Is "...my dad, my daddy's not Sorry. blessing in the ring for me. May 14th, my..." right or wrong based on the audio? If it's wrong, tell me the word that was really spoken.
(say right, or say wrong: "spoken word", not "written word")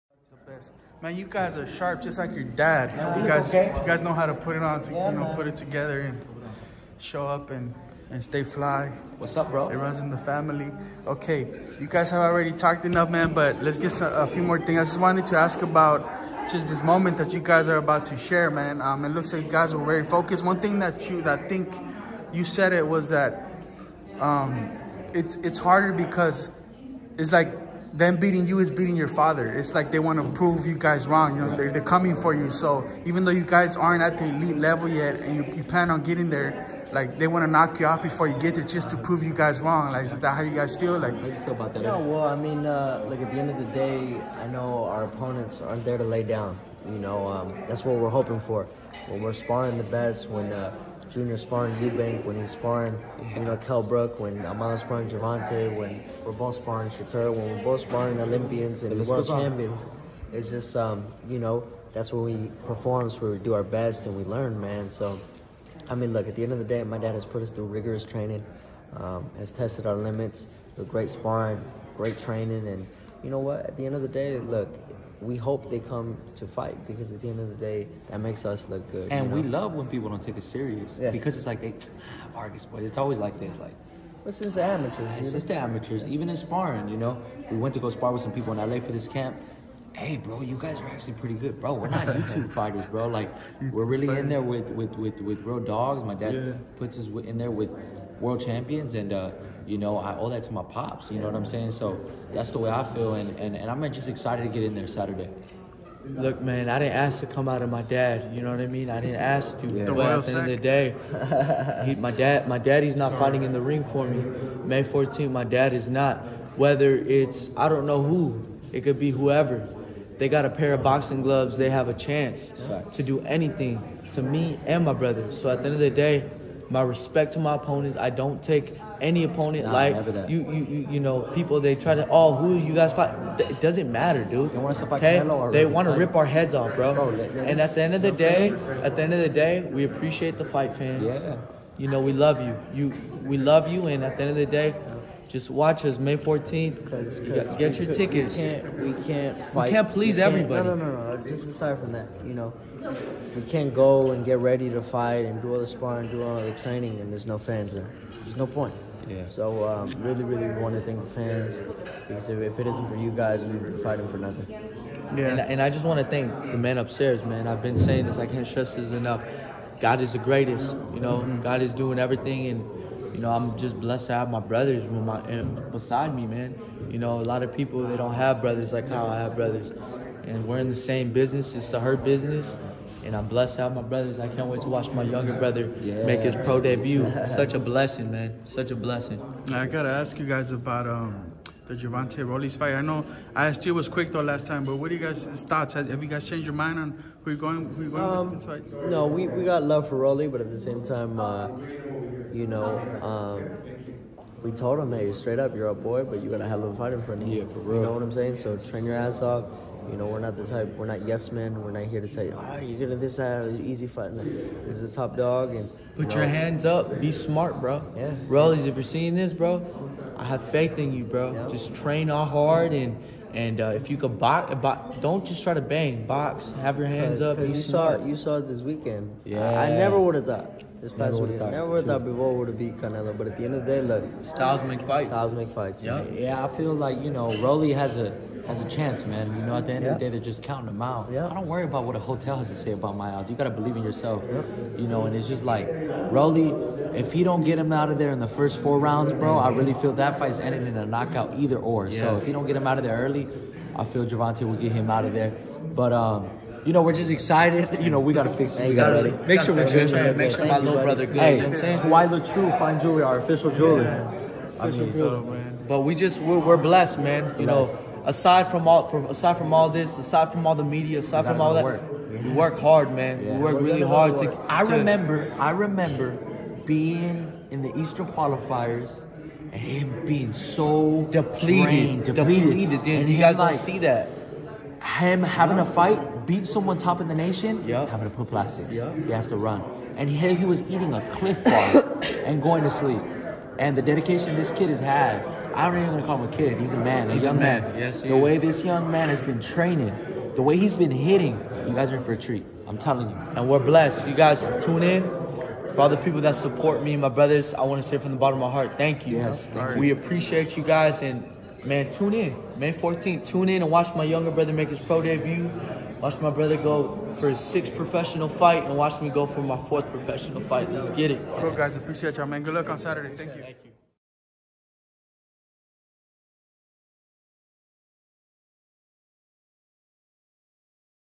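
wrong: "fighting", not "blessing".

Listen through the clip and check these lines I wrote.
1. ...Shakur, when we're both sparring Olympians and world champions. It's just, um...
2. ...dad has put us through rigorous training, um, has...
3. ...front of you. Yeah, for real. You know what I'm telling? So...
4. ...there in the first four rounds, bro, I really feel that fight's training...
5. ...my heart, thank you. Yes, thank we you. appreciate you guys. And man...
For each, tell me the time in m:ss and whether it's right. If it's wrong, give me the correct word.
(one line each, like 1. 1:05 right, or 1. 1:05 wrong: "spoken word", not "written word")
1. 0:56 right
2. 1:06 right
3. 3:27 wrong: "saying", not "telling"
4. 4:07 wrong: "ending", not "training"
5. 5:08 right.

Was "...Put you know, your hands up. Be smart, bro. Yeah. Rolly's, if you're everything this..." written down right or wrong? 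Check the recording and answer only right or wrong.
wrong.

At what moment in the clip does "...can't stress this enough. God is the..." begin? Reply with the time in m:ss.
2:48.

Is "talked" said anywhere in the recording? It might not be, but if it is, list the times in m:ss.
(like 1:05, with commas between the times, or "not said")
0:12.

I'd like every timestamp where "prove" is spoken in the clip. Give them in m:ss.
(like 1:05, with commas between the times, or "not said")
0:30, 0:38.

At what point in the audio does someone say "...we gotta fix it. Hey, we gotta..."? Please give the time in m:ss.
4:17.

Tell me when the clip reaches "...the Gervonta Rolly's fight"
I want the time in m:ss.
3:11.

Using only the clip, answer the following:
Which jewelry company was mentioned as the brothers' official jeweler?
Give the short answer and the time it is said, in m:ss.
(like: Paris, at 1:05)
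Twyla True, at 4:21.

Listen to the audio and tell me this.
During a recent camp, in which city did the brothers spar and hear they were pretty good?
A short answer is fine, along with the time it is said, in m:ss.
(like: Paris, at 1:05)
LA, at 1:28.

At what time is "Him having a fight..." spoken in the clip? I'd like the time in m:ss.
4:44.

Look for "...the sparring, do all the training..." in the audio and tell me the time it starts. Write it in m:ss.
2:35.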